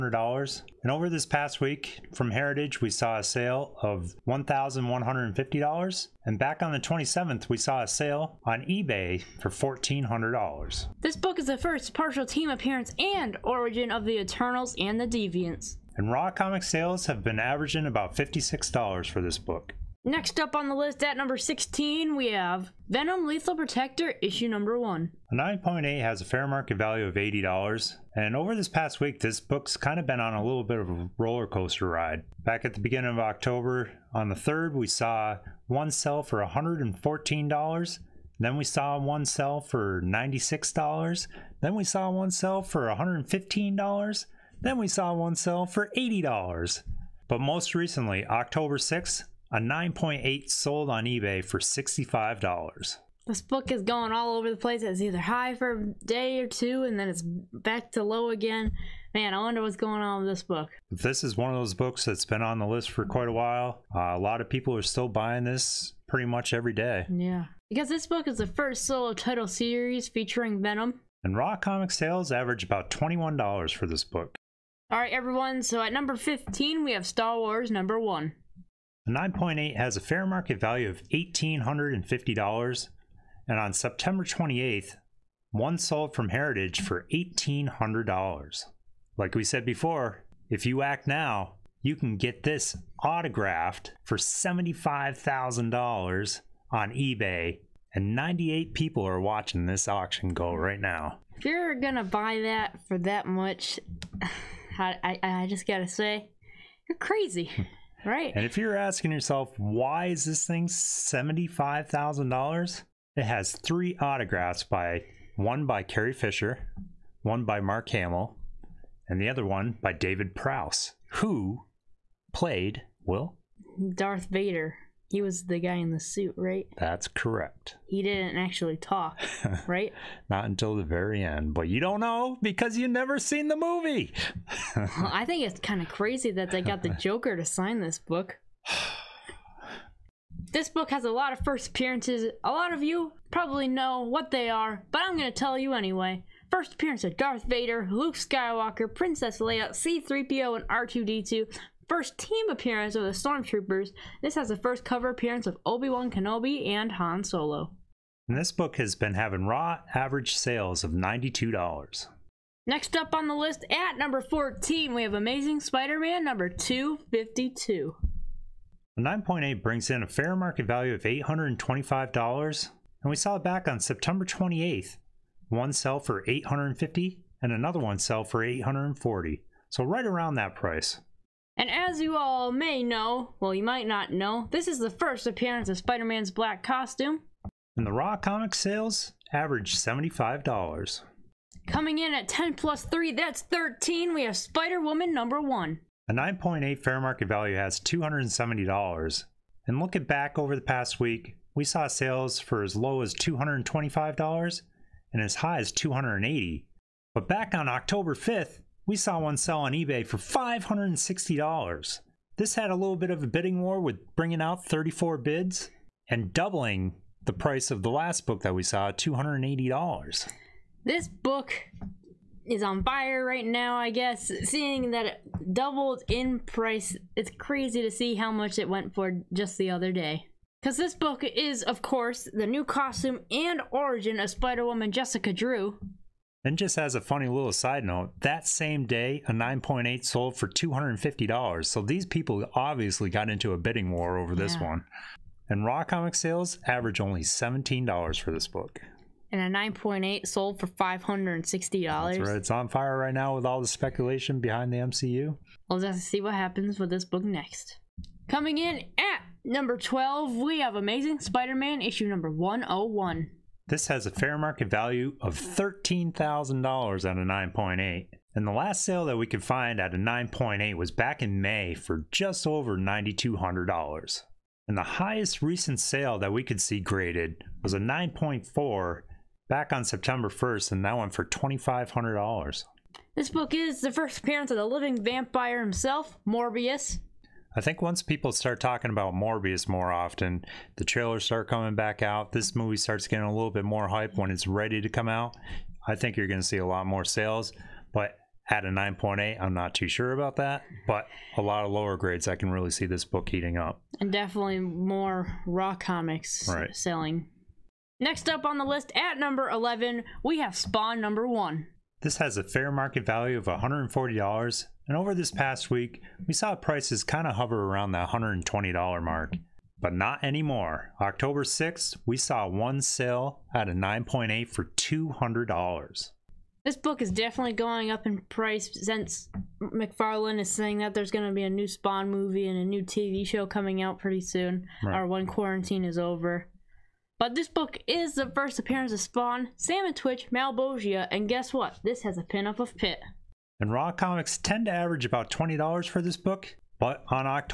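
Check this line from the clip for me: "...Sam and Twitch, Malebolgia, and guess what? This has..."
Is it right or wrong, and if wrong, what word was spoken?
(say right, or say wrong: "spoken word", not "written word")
right.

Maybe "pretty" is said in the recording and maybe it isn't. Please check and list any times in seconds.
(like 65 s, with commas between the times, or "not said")
66 s, 333 s.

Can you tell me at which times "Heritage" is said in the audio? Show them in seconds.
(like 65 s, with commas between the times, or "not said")
2 s, 86 s.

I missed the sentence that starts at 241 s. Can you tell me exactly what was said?
So these people obviously got into a bidding war over this yeah.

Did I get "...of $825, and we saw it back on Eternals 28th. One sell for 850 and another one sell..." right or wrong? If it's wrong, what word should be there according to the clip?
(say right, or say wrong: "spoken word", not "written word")
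wrong: "September", not "Eternals".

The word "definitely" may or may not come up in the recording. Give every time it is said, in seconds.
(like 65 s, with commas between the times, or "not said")
304 s, 327 s.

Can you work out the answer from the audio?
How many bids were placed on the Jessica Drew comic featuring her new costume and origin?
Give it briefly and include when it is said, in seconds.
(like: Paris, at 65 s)
34, at 214 s.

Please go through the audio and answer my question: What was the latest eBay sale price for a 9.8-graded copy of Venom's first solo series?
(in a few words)
$65.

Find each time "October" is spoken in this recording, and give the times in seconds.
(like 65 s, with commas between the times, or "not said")
33 s, 48 s, 207 s, 320 s.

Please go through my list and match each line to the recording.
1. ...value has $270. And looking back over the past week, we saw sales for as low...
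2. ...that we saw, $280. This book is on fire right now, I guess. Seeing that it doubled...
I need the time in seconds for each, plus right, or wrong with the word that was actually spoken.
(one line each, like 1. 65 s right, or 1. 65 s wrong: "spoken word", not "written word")
1. 197 s right
2. 218 s right.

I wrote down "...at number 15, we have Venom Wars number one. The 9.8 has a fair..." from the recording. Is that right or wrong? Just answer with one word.
wrong.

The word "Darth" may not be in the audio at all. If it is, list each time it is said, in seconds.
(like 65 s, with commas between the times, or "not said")
123 s, 147 s.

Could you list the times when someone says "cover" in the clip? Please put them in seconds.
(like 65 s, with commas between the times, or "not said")
154 s.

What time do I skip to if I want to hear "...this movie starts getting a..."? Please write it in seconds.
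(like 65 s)
292 s.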